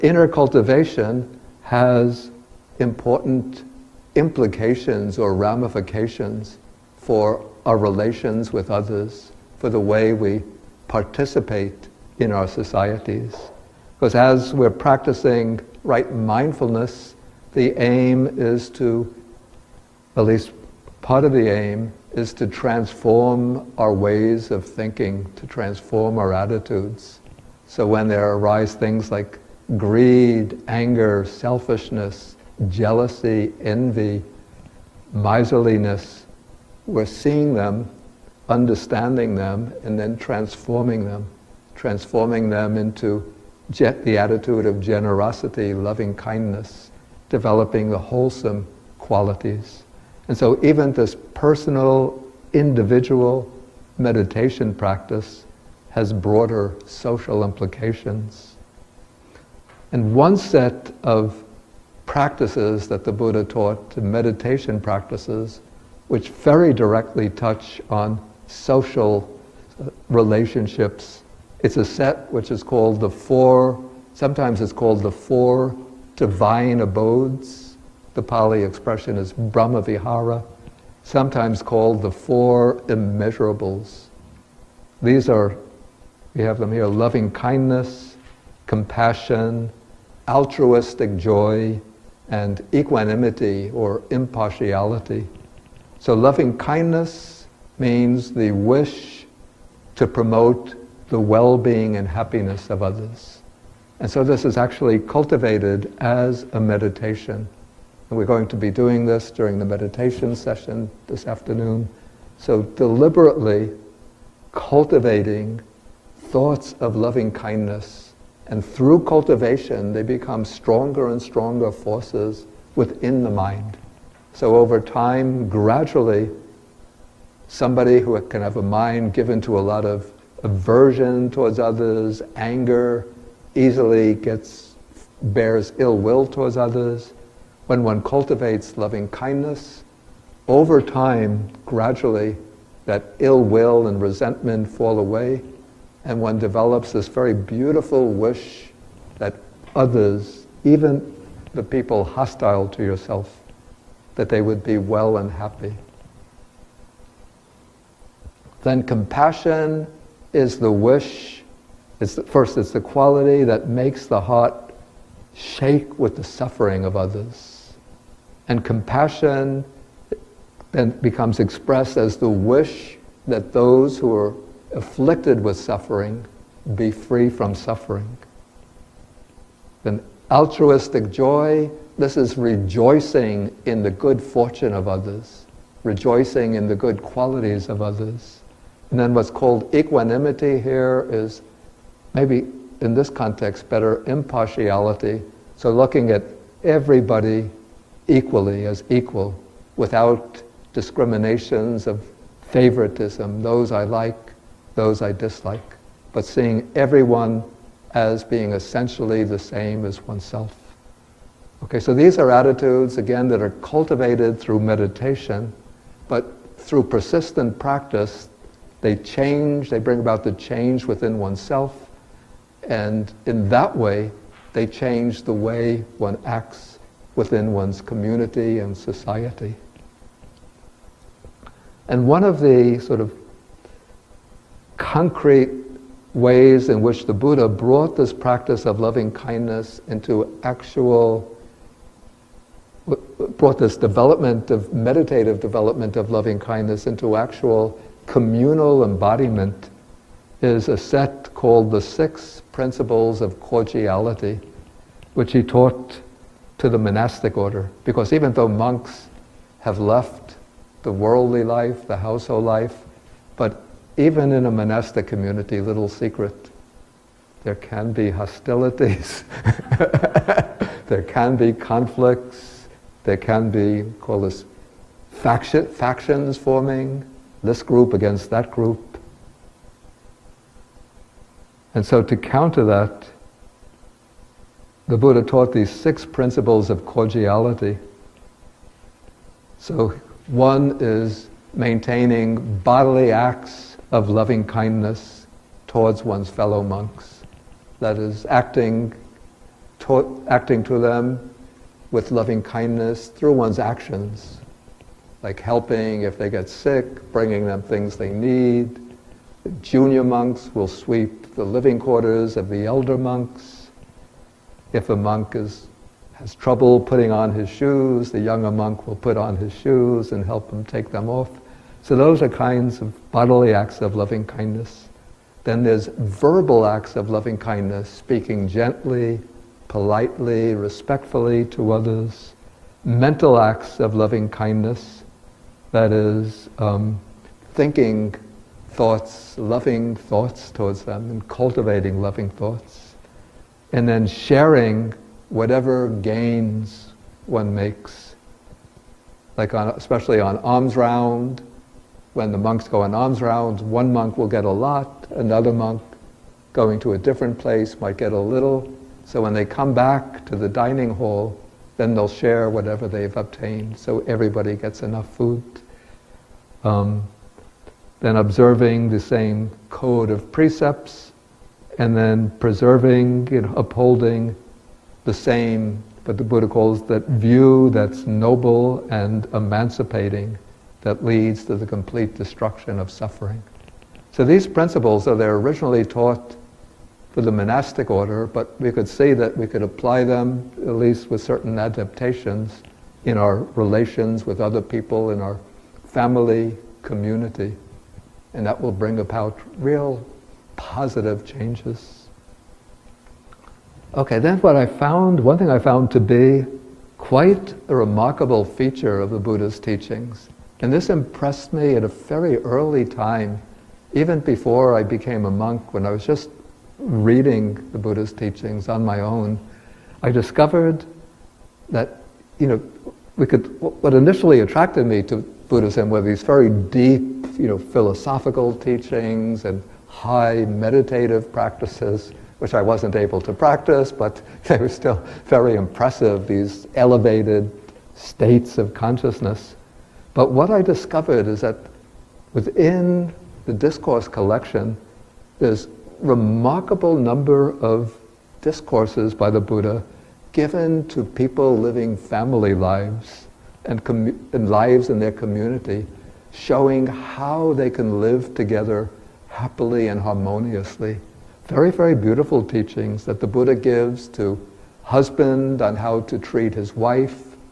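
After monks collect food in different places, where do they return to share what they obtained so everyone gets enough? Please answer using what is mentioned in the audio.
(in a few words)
dining hall.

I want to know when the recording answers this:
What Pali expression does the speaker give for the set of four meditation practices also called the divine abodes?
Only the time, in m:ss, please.
1:19.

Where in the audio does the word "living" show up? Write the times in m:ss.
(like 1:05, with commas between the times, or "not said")
5:11, 7:31.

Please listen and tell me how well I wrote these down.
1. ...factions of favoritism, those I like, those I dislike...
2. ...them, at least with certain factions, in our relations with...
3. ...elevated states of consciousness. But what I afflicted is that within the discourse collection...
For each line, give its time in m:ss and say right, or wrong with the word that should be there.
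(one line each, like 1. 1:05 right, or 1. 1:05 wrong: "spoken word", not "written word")
1. 3:20 wrong: "discriminations", not "factions"
2. 6:30 wrong: "adaptations", not "factions"
3. 7:16 wrong: "discovered", not "afflicted".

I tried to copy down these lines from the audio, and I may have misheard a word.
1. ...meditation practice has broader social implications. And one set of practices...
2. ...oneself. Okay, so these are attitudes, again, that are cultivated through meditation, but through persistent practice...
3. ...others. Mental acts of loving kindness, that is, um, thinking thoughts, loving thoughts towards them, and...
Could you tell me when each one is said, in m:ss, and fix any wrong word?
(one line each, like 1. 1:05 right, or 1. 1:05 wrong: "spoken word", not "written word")
1. 0:53 right
2. 3:30 right
3. 5:31 right.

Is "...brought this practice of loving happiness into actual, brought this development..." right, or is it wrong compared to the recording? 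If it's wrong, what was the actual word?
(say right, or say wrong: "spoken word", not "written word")
wrong: "kindness", not "happiness".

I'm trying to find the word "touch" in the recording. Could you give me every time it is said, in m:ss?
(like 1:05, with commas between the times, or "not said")
1:07.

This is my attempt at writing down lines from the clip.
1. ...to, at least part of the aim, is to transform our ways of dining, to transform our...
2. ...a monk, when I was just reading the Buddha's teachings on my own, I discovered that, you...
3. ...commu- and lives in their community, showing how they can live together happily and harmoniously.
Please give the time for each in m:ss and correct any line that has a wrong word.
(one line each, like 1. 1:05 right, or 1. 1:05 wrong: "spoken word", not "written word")
1. 0:18 wrong: "thinking", not "dining"
2. 6:55 right
3. 7:33 right.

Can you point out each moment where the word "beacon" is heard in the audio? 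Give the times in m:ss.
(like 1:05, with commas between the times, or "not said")
not said.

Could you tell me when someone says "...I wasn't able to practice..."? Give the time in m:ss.
7:12.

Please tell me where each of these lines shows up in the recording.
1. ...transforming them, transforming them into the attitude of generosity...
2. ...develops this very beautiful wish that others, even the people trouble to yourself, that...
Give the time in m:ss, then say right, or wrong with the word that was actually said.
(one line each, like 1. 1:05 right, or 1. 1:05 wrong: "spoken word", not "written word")
1. 0:40 right
2. 2:26 wrong: "hostile", not "trouble".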